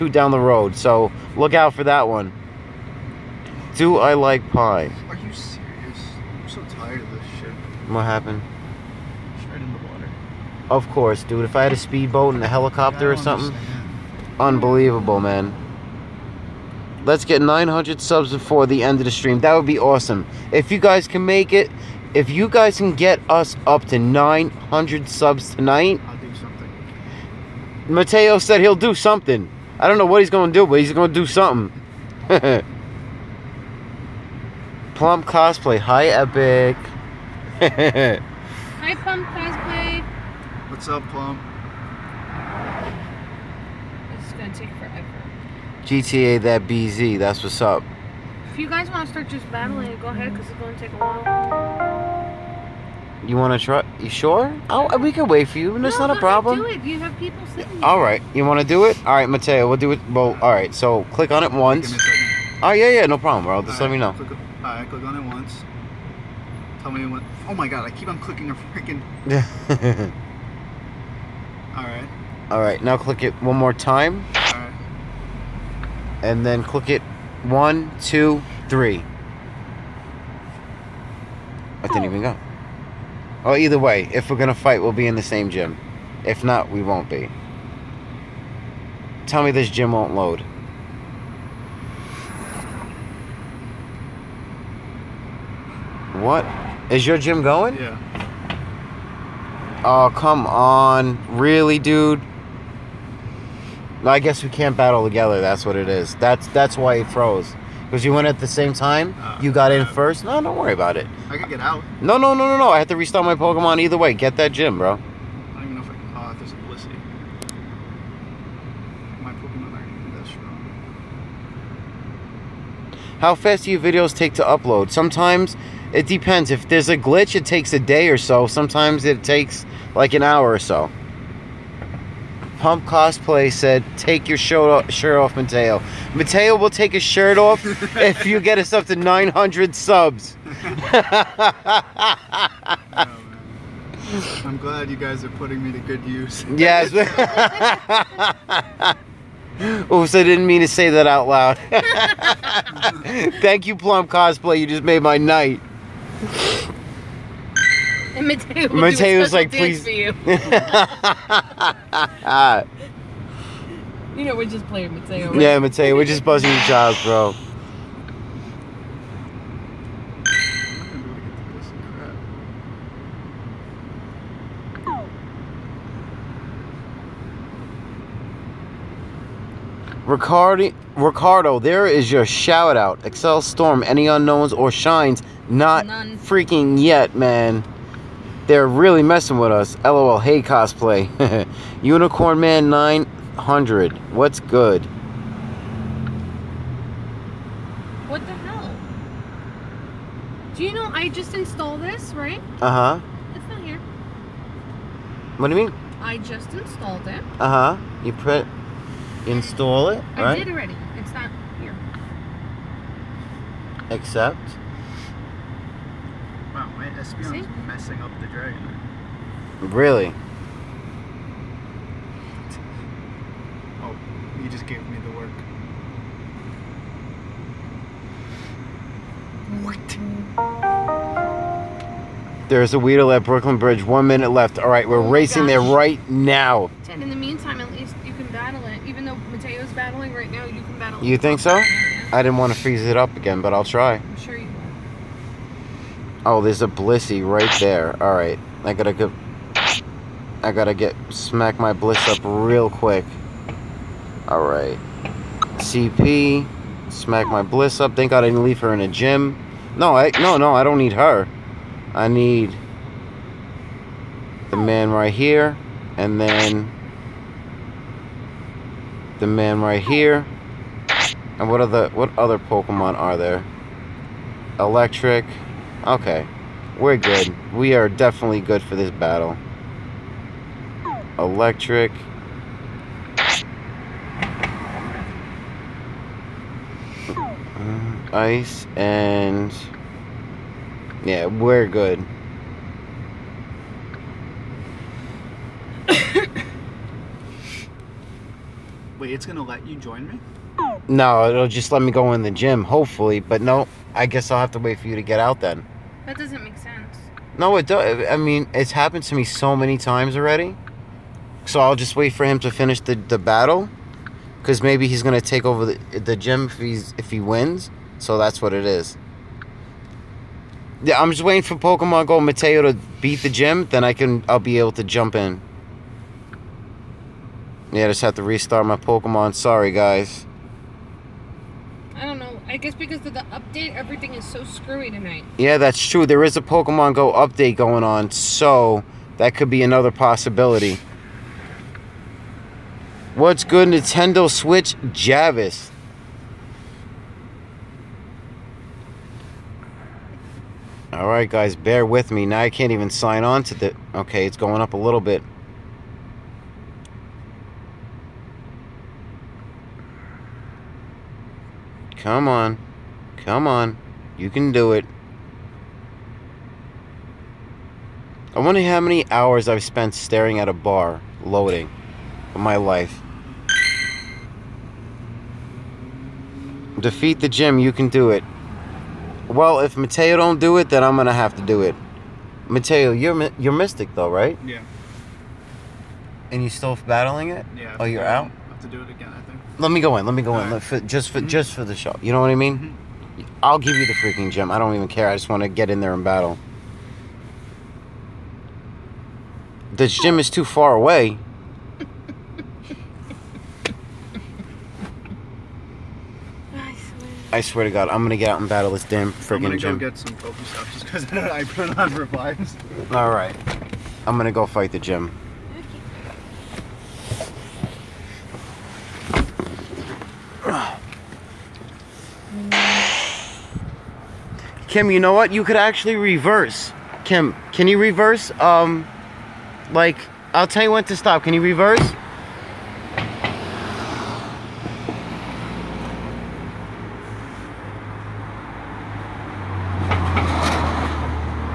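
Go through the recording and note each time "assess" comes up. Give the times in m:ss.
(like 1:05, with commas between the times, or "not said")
not said.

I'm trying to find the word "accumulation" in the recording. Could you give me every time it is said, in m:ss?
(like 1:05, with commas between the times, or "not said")
not said.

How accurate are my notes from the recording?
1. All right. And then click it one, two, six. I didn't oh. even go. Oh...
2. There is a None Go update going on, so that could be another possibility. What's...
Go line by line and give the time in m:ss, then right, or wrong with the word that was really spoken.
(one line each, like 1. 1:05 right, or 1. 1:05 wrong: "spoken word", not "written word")
1. 1:14 wrong: "three", not "six"
2. 5:36 wrong: "Pokemon", not "None".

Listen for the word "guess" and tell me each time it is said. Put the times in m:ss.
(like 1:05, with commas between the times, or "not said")
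1:44, 5:04, 5:32.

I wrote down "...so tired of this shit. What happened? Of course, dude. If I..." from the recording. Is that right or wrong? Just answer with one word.
right.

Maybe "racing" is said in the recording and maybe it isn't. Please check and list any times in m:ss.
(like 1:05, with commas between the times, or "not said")
3:55.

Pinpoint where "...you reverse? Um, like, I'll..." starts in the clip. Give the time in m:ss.
7:07.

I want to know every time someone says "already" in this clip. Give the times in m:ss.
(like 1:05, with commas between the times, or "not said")
3:30, 5:10.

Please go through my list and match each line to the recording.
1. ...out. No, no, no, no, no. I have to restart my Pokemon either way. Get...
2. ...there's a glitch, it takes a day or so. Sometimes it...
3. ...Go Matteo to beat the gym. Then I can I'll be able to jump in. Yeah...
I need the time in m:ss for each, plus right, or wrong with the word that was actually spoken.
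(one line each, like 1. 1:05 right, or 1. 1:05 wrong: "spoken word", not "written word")
1. 1:51 right
2. 2:06 right
3. 5:22 right.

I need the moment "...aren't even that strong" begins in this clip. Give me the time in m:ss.
1:59.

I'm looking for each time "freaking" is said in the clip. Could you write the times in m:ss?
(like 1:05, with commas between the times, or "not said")
1:08, 3:06, 6:33, 6:49.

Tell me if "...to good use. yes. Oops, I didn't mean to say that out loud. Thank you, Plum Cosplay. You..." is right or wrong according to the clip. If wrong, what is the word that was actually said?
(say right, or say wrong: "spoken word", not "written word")
right.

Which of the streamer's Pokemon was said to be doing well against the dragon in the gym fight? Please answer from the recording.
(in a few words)
Espeon.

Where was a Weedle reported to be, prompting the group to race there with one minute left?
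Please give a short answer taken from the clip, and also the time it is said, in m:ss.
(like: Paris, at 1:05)
Brooklyn Bridge, at 3:53.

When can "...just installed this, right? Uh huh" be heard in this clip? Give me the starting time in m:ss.
3:21.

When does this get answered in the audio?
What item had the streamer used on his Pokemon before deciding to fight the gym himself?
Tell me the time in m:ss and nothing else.
6:51.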